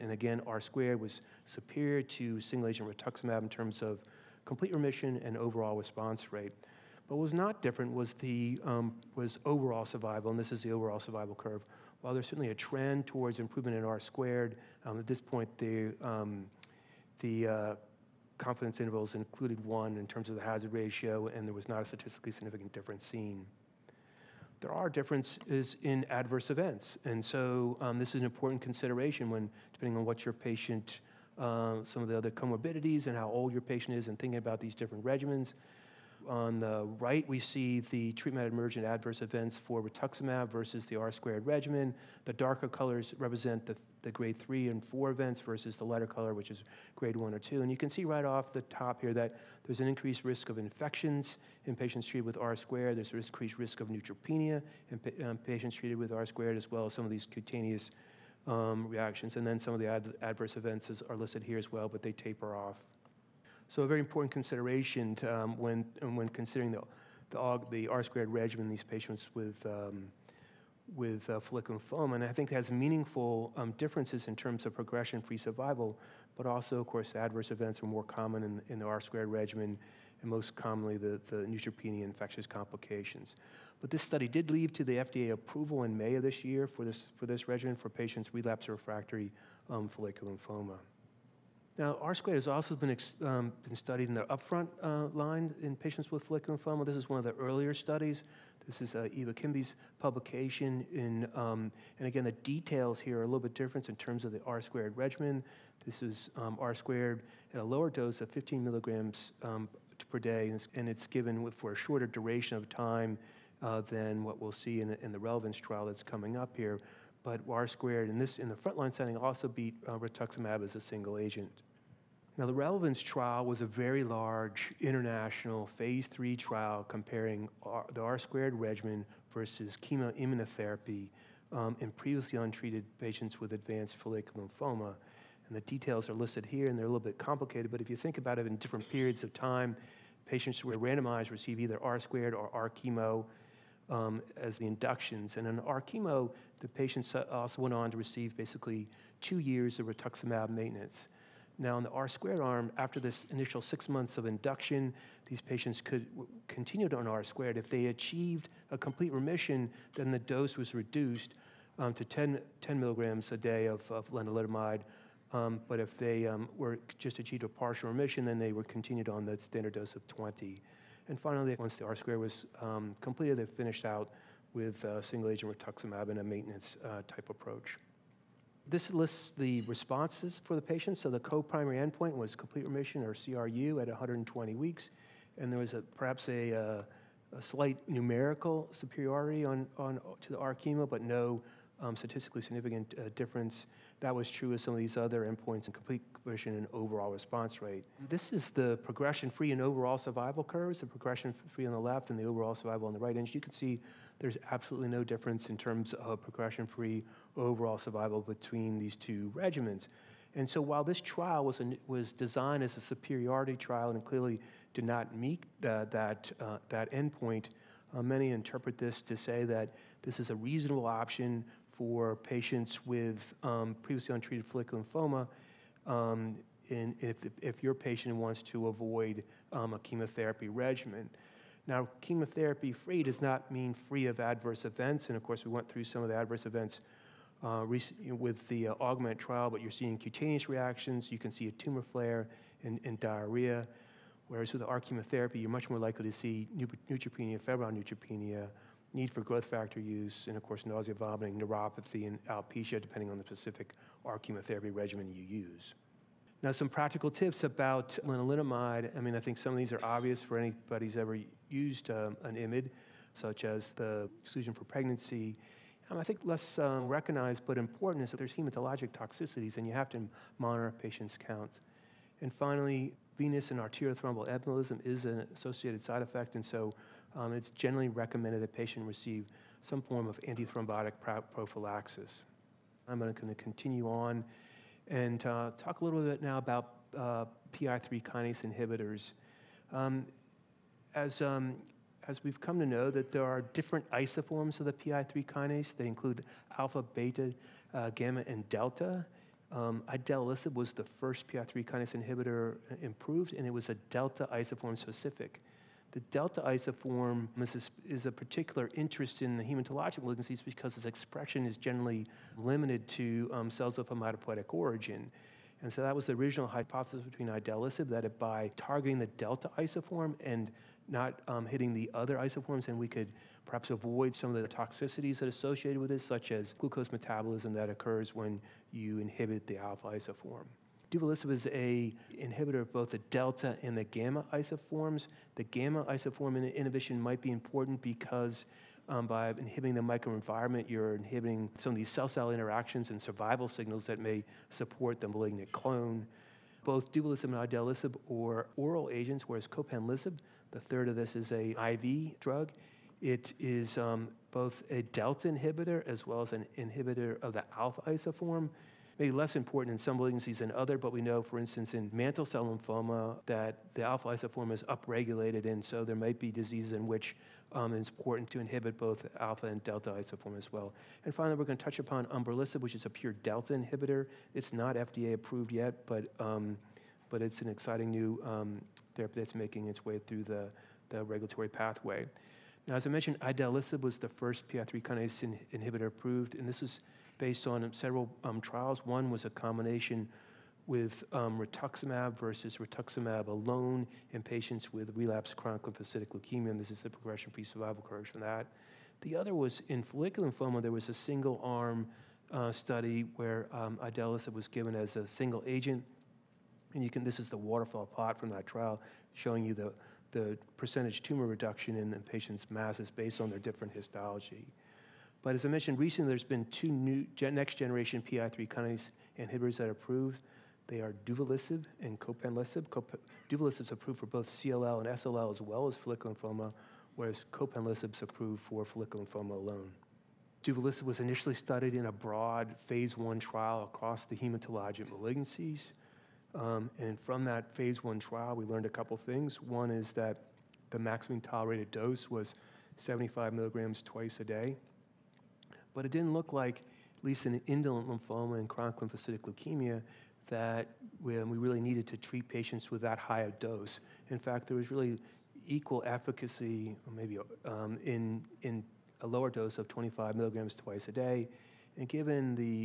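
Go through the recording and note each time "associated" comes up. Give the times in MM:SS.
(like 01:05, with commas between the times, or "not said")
04:35, 05:25.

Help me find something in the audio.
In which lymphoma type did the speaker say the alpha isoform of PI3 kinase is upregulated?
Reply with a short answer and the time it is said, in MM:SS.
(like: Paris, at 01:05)
mantle cell lymphoma, at 06:01.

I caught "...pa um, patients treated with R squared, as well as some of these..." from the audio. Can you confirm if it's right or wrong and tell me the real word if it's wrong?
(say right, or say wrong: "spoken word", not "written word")
right.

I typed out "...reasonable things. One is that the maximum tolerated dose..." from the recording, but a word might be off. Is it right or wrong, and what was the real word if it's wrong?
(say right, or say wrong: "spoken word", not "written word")
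wrong: "couple", not "reasonable".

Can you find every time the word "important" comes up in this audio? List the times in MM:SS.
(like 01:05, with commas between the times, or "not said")
00:28, 01:03, 04:27, 05:37, 05:59, 06:07.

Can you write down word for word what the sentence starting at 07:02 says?
Cop- duvelisib is approved for both CLL and SLL as well as follicular lymphoma, whereas copanlisib is approved for follicular lymphoma alone.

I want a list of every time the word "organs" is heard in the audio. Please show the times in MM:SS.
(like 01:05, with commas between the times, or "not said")
not said.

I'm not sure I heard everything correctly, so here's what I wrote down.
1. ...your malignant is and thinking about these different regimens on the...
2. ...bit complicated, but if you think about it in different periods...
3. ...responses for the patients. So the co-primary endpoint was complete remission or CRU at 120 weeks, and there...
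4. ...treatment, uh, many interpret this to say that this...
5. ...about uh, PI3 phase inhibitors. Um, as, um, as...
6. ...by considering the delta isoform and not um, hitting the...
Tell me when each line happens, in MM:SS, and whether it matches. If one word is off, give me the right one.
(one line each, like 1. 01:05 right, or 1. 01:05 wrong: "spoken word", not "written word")
1. 00:33 wrong: "patient", not "malignant"
2. 02:16 right
3. 02:59 right
4. 03:36 wrong: "endpoint", not "treatment"
5. 04:46 wrong: "kinase", not "phase"
6. 05:18 wrong: "targeting", not "considering".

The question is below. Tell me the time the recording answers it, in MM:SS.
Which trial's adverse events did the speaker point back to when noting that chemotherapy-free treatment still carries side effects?
03:58.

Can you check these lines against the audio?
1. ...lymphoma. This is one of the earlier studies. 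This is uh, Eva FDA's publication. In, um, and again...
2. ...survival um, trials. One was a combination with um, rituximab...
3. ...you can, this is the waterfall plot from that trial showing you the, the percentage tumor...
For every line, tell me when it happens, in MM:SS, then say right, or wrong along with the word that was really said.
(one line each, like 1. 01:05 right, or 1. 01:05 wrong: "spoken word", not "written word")
1. 01:36 wrong: "Kimby", not "FDA"
2. 06:27 wrong: "several", not "survival"
3. 06:46 right.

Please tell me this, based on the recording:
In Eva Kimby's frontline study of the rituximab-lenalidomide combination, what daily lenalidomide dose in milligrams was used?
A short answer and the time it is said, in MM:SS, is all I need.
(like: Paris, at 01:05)
15, at 01:48.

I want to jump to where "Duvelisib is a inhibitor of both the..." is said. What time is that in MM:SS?
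05:30.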